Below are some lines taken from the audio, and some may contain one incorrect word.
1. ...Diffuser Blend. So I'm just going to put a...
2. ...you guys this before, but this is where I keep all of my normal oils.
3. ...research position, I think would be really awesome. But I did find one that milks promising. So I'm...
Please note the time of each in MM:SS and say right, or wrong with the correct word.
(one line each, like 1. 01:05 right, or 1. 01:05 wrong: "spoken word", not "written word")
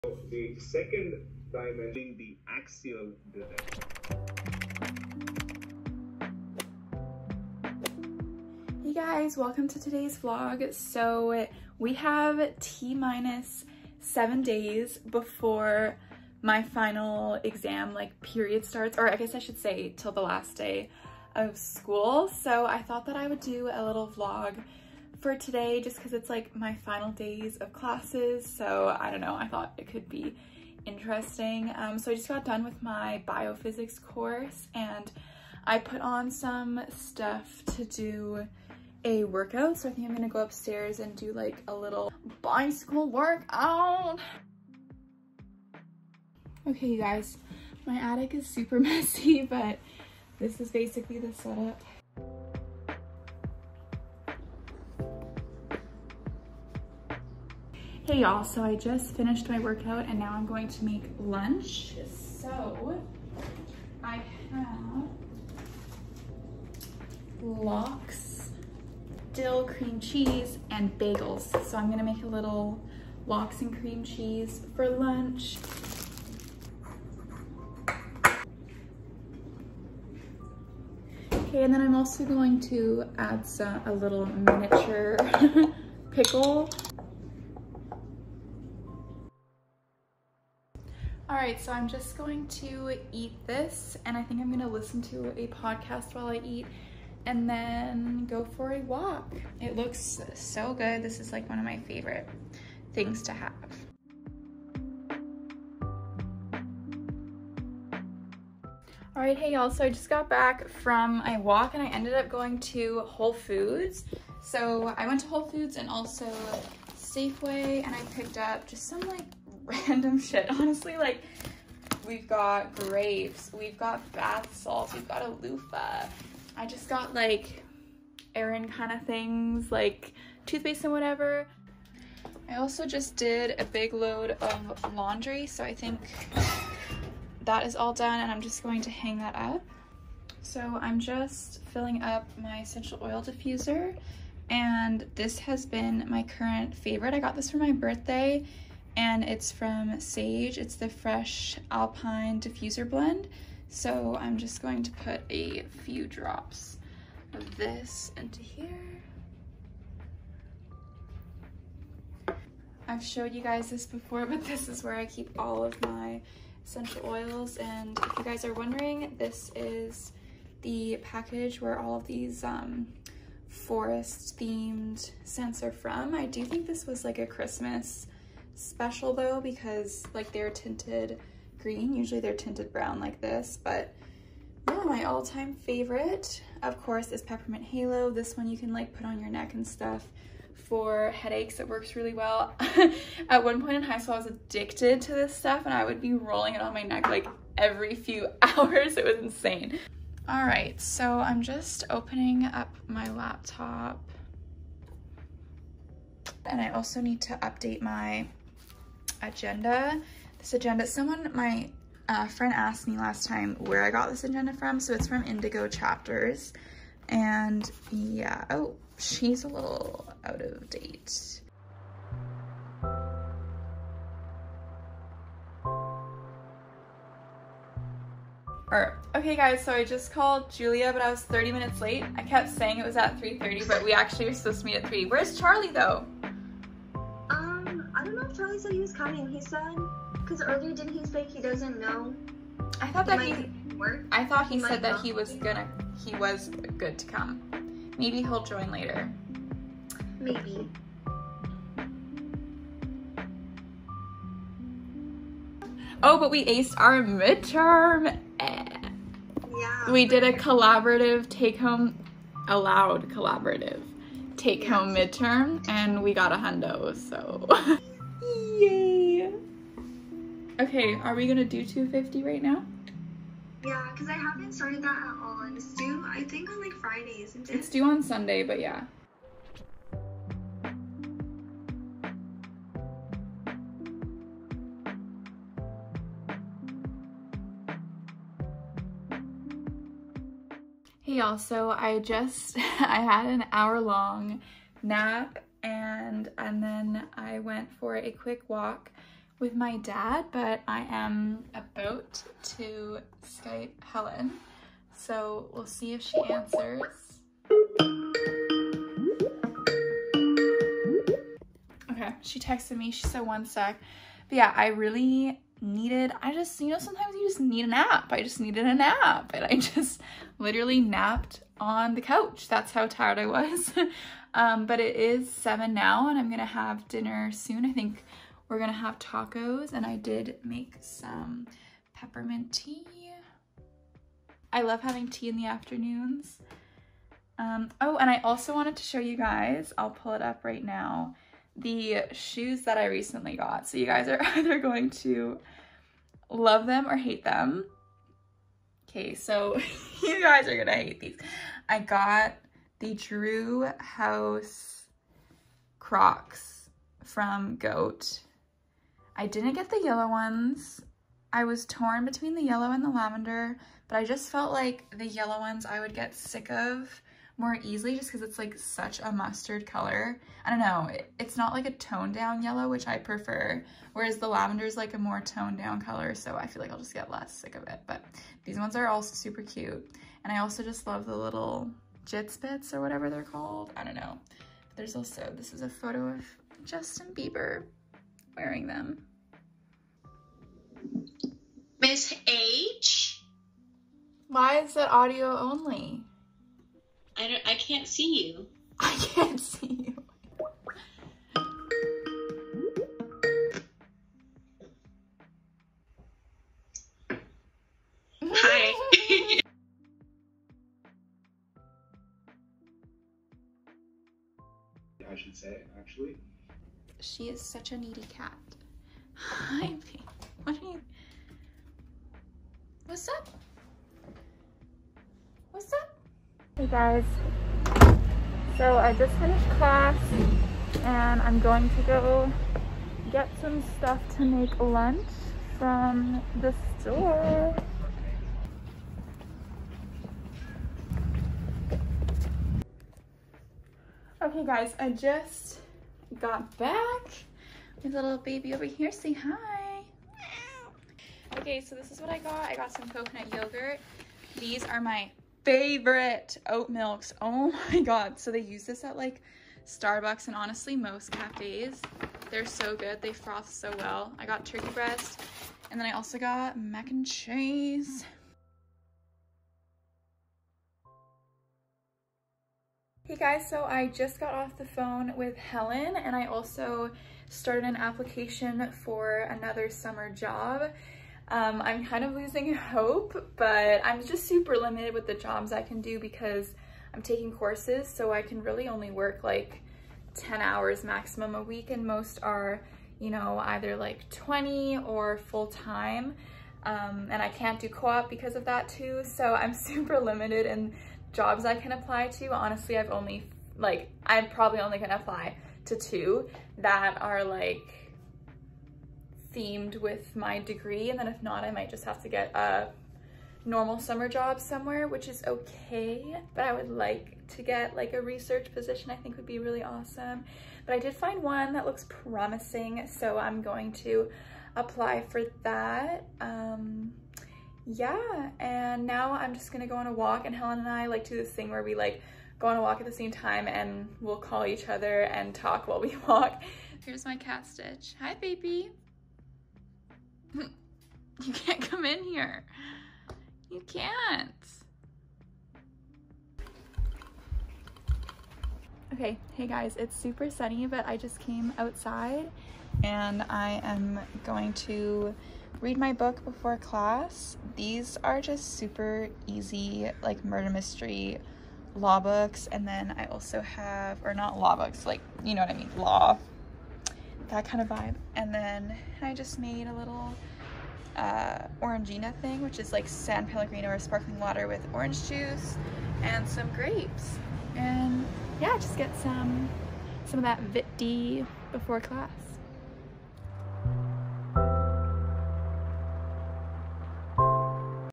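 1. 02:32 right
2. 02:43 wrong: "essential", not "normal"
3. 08:38 wrong: "looks", not "milks".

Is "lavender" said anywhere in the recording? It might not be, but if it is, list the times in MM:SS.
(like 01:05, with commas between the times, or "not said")
06:02, 06:14.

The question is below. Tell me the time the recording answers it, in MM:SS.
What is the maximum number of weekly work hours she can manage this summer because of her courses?
08:10.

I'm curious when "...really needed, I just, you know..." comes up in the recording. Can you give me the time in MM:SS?
05:14.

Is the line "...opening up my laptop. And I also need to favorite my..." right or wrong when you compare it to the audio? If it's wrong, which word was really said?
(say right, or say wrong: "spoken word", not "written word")
wrong: "update", not "favorite".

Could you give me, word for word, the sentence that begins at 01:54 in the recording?
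So I went to Whole Foods and also Safeway and I picked up just some like random shit.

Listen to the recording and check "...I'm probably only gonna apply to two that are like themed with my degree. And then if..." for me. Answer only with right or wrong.
right.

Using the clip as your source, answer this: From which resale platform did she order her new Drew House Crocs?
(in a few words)
Goat.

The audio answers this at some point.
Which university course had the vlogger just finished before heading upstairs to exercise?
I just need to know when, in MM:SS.
00:33.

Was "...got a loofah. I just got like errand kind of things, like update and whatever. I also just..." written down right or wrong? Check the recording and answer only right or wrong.
wrong.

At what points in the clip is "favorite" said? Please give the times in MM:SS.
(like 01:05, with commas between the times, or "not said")
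01:41, 02:26, 03:05, 07:35.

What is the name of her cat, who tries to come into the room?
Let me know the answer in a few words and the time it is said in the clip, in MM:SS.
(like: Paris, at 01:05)
Stitch, at 08:57.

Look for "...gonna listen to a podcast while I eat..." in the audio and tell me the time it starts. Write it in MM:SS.
01:34.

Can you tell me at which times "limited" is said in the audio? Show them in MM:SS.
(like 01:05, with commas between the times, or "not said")
08:04, 08:19.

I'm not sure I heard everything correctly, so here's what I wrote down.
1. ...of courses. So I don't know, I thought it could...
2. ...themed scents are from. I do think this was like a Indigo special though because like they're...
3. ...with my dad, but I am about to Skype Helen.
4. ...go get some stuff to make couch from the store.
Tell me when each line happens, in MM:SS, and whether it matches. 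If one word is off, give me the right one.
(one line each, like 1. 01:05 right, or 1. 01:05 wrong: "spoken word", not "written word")
1. 00:27 wrong: "classes", not "courses"
2. 02:54 wrong: "Christmas", not "Indigo"
3. 04:59 right
4. 07:11 wrong: "lunch", not "couch".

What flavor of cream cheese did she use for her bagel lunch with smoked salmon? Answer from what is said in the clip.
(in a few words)
Dill.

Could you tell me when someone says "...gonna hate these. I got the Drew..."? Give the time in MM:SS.
05:50.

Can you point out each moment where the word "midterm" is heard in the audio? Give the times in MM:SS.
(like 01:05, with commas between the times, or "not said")
04:17, 04:25.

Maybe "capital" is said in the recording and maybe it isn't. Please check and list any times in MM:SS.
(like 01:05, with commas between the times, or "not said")
not said.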